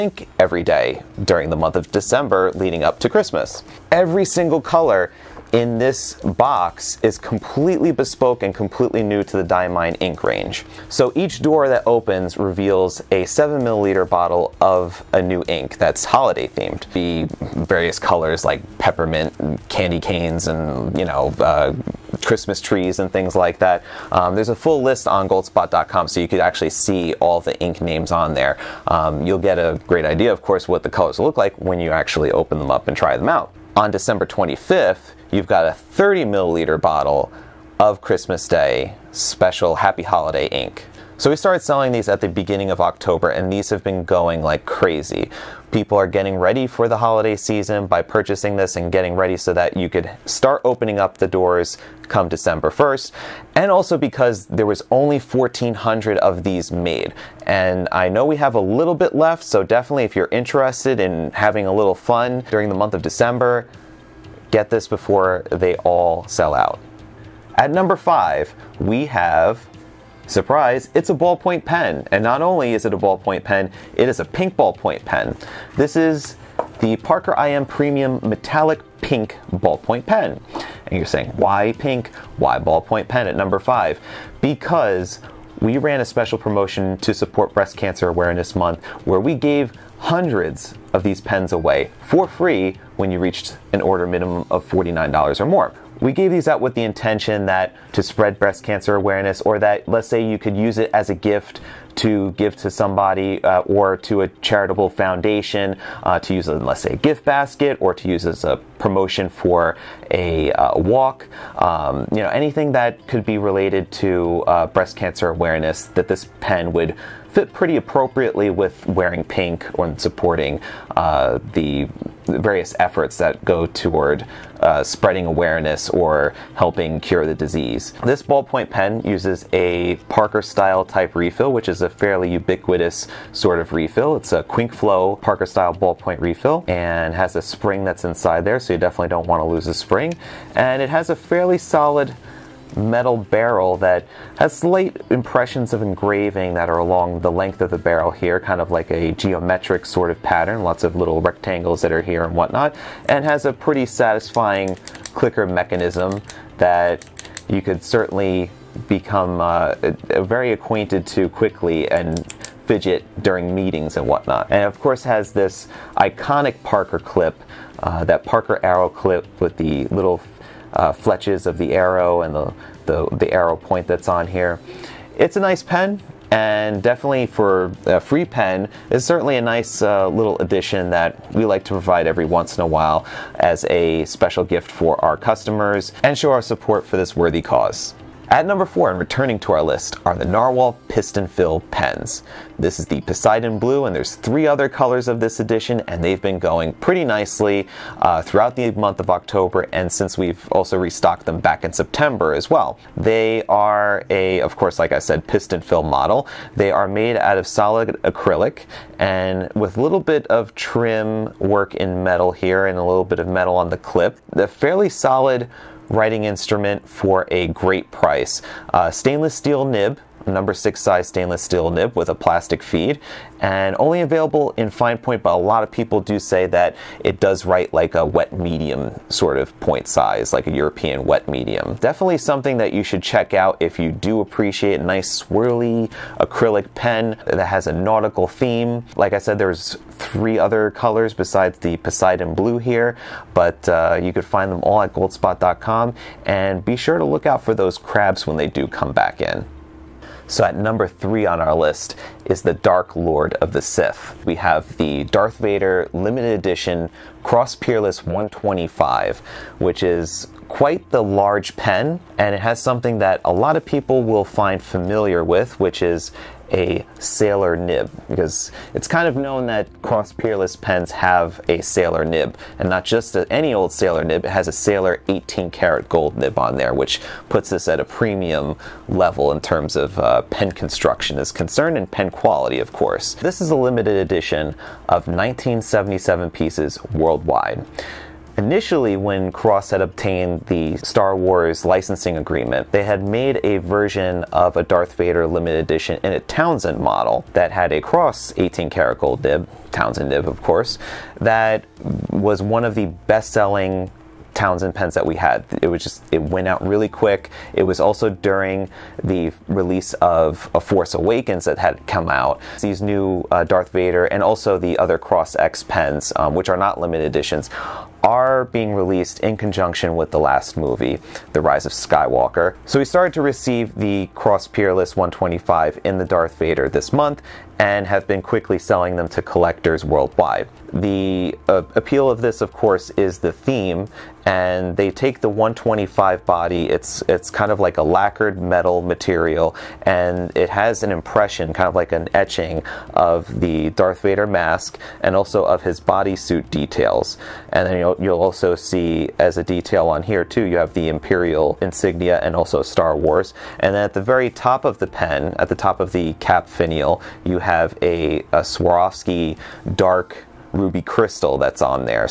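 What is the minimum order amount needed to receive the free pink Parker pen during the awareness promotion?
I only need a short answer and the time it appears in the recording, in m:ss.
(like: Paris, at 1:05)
$49, at 1:34.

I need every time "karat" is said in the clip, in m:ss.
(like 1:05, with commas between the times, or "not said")
4:35, 4:58.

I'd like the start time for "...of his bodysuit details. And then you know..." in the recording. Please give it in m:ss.
5:45.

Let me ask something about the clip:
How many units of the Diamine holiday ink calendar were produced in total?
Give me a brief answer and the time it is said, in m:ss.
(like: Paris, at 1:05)
1400, at 0:55.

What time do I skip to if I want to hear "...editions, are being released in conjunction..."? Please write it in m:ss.
5:17.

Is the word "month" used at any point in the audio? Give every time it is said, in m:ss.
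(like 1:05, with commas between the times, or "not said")
0:01, 1:02, 1:28, 3:18, 5:26.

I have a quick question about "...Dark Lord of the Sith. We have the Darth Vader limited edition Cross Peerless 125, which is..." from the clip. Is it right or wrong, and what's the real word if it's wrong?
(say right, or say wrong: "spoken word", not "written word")
right.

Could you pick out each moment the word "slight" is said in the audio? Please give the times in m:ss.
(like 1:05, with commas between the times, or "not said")
2:24.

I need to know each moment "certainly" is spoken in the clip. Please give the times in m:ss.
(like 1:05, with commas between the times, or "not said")
2:37, 2:59.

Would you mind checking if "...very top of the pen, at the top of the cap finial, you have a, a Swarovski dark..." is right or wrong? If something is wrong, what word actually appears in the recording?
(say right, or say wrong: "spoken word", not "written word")
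right.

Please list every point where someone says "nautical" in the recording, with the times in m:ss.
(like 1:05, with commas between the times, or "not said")
3:57.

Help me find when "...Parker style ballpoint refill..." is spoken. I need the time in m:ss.
2:15.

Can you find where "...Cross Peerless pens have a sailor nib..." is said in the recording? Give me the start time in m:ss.
4:29.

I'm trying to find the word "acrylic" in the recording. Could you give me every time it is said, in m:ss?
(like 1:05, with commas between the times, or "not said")
3:28, 3:56.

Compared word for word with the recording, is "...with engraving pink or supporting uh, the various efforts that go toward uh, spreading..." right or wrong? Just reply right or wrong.
wrong.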